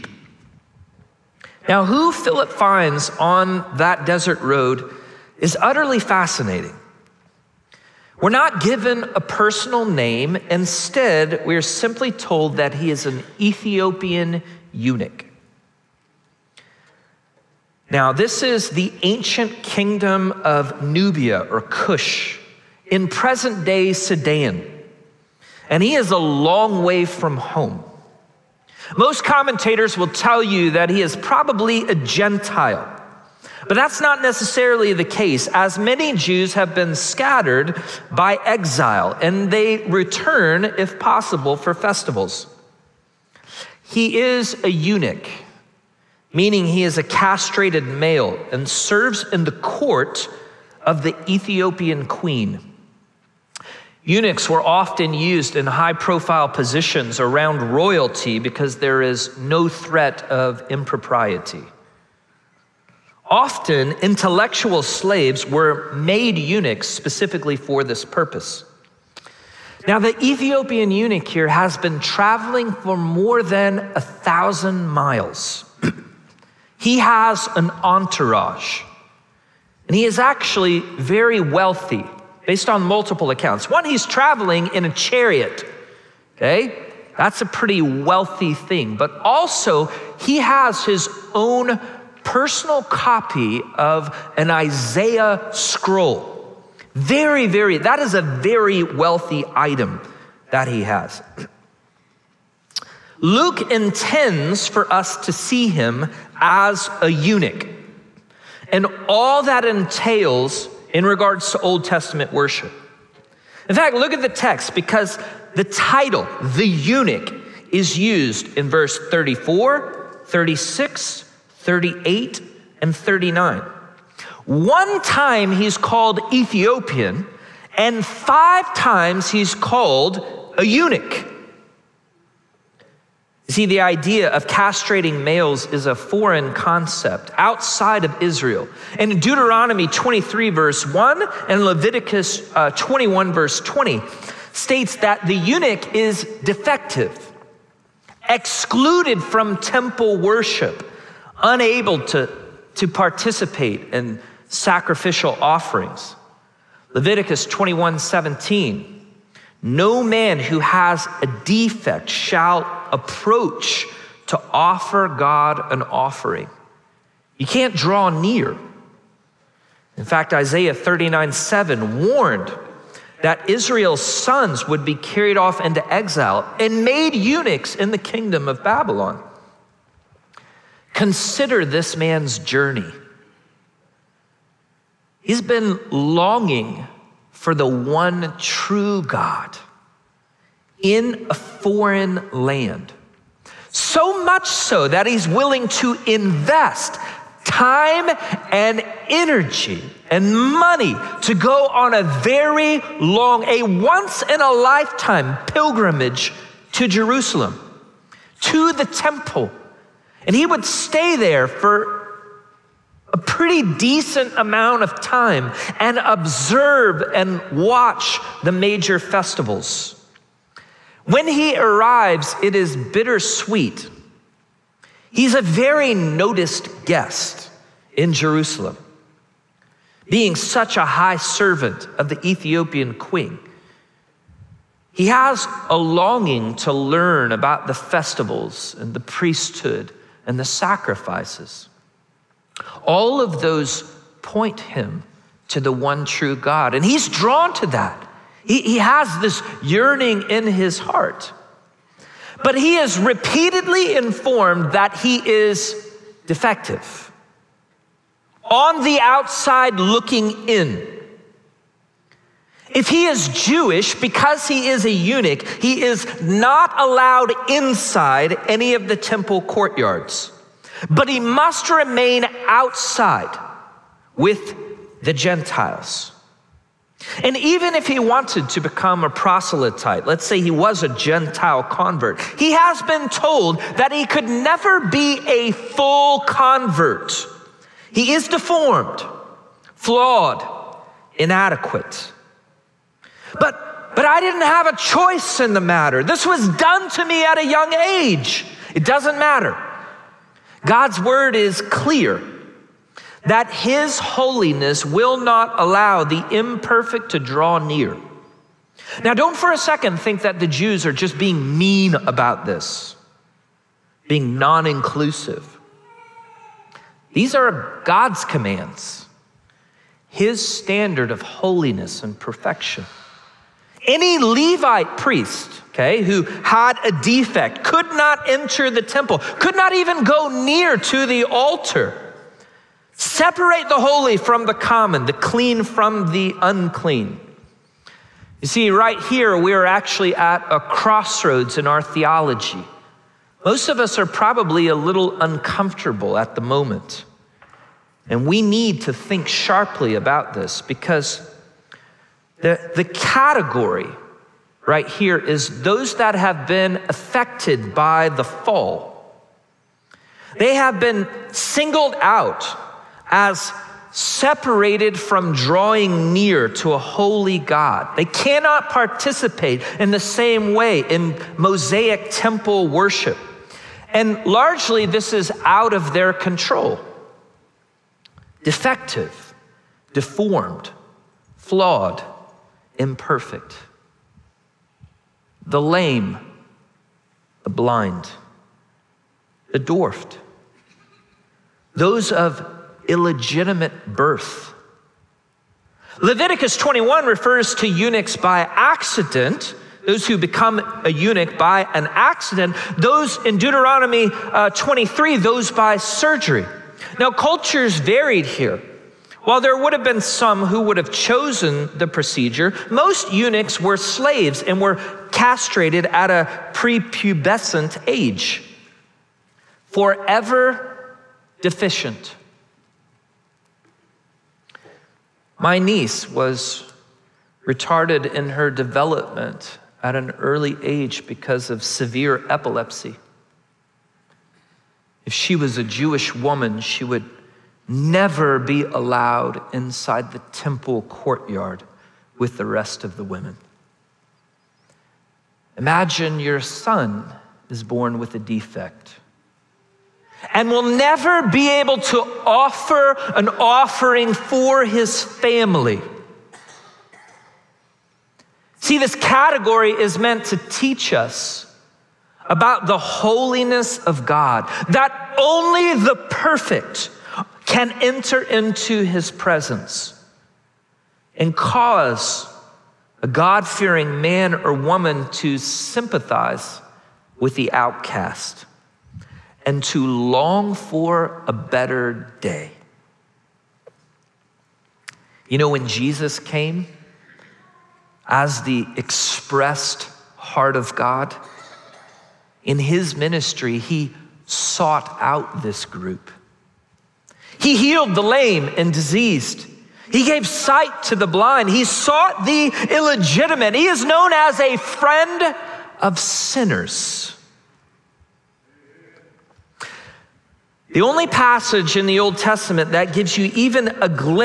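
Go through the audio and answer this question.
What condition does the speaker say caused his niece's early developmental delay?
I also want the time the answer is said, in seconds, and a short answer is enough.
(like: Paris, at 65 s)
Severe epilepsy, at 431 s.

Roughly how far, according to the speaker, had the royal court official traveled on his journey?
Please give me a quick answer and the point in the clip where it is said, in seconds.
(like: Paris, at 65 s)
More than 1000 miles, at 72 s.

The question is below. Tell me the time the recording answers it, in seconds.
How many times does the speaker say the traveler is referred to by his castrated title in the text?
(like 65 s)
128 s.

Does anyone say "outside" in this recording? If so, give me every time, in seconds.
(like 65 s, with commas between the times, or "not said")
137 s, 259 s, 272 s.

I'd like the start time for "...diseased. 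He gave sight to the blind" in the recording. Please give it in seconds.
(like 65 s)
498 s.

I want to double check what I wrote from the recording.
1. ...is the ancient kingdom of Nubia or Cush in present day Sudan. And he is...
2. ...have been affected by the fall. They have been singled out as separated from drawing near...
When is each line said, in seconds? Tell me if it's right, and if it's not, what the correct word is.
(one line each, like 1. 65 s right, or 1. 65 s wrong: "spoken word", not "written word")
1. 18 s right
2. 356 s right.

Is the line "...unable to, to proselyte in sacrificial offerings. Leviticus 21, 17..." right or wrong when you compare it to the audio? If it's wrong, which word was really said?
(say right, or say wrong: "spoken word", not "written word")
wrong: "participate", not "proselyte".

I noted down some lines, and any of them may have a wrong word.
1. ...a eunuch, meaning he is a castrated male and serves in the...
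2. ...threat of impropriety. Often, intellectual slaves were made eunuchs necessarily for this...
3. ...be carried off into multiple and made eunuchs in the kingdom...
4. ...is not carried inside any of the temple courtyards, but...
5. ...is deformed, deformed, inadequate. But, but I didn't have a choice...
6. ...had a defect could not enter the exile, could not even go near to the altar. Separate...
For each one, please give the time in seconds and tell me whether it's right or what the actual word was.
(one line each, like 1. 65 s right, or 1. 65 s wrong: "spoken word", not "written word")
1. 44 s right
2. 59 s wrong: "specifically", not "necessarily"
3. 174 s wrong: "exile", not "multiple"
4. 265 s wrong: "allowed", not "carried"
5. 288 s wrong: "flawed", not "deformed"
6. 326 s wrong: "temple", not "exile".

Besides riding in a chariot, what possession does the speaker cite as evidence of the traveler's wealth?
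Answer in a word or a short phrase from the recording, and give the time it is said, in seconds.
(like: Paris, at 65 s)
An Isaiah scroll, at 94 s.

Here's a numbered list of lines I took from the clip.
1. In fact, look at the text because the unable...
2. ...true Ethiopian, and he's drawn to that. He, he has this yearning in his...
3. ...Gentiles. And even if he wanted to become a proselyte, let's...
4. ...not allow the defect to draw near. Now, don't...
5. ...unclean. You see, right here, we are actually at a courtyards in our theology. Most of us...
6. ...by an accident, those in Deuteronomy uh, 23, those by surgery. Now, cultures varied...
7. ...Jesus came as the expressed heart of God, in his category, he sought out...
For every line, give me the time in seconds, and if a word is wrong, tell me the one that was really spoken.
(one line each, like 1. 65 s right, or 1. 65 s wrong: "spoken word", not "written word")
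1. 113 s wrong: "title", not "unable"
2. 246 s wrong: "God", not "Ethiopian"
3. 275 s right
4. 305 s wrong: "imperfect", not "defect"
5. 336 s wrong: "crossroads", not "courtyards"
6. 401 s right
7. 485 s wrong: "ministry", not "category".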